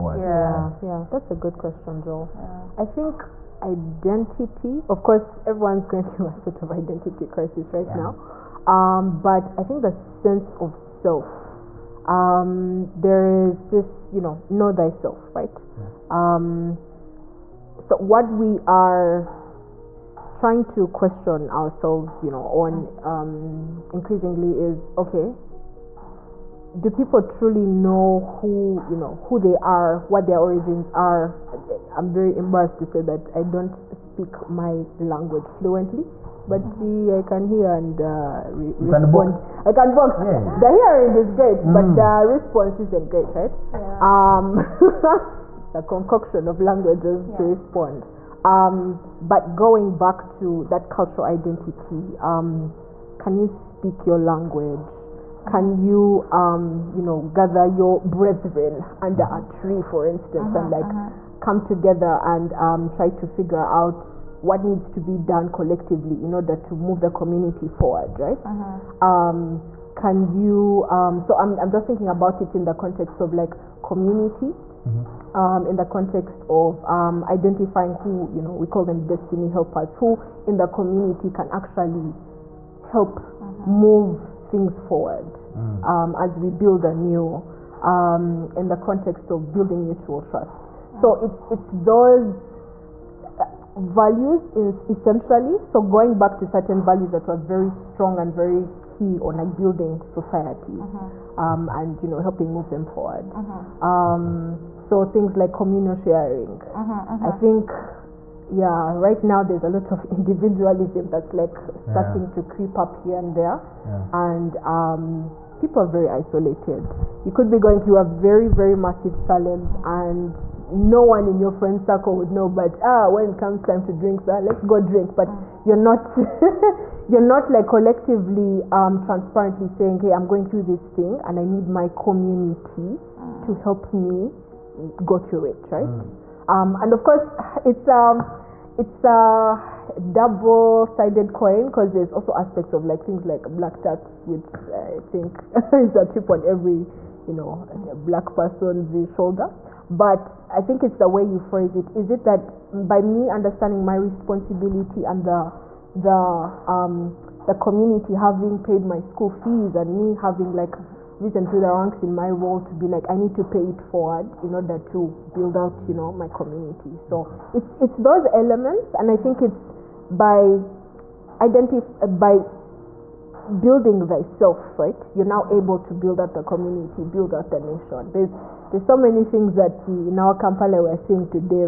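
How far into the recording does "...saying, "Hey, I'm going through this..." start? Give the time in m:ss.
2:09.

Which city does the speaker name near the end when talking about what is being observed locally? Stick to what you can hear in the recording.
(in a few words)
Kampala.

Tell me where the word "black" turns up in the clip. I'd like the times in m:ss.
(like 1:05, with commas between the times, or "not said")
2:23, 2:28.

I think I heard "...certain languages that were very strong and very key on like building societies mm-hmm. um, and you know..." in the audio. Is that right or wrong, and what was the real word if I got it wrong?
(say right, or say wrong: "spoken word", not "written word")
wrong: "values", not "languages".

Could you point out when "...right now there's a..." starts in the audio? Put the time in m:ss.
1:48.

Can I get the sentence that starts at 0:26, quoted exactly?
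Do people truly know who you know who they are, what their origins are?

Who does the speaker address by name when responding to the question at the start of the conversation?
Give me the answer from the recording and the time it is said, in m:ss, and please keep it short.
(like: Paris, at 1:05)
Joel, at 0:02.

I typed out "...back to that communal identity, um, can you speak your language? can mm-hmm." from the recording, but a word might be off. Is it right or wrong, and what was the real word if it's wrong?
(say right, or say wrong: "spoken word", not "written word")
wrong: "cultural", not "communal".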